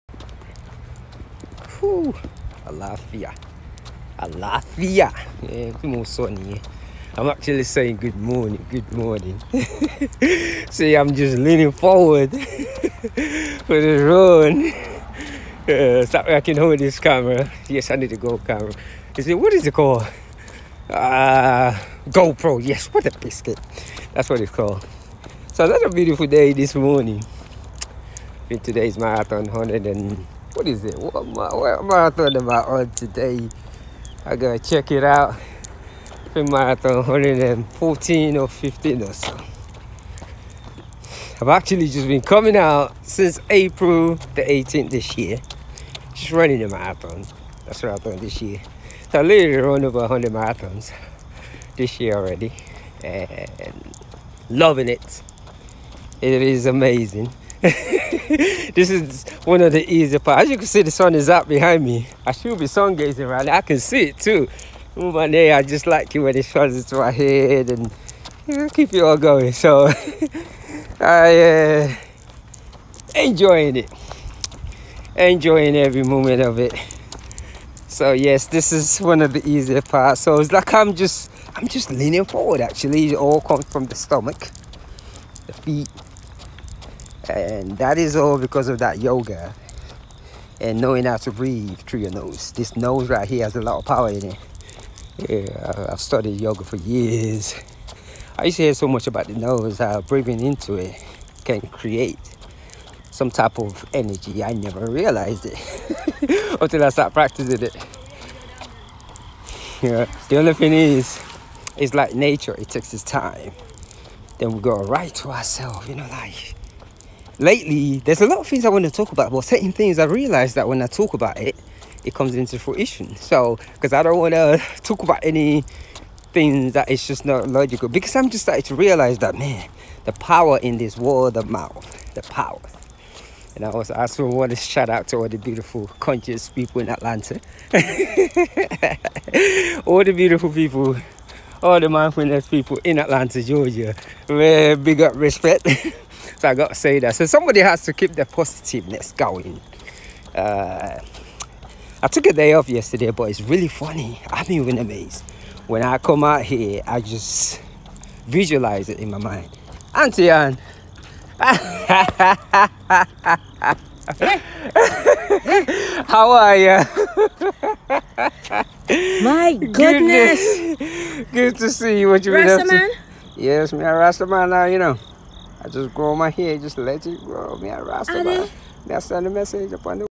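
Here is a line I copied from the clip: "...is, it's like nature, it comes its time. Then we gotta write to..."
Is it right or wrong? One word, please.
wrong.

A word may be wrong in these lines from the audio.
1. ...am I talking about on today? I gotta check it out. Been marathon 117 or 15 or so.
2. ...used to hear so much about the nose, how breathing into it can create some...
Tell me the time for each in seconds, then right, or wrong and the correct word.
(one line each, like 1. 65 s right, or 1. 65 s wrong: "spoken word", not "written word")
1. 31 s wrong: "114", not "117"
2. 98 s right.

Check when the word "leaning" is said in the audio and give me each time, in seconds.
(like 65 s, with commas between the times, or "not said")
11 s, 81 s.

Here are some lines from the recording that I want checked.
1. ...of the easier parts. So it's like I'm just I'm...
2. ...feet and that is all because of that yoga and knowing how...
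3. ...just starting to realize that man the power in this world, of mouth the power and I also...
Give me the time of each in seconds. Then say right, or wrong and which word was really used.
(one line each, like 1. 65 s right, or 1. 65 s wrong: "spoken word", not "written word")
1. 79 s right
2. 85 s right
3. 128 s right.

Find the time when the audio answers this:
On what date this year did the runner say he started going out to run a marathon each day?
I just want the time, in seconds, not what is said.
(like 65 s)
43 s.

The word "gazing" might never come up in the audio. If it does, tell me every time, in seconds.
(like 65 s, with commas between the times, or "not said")
62 s.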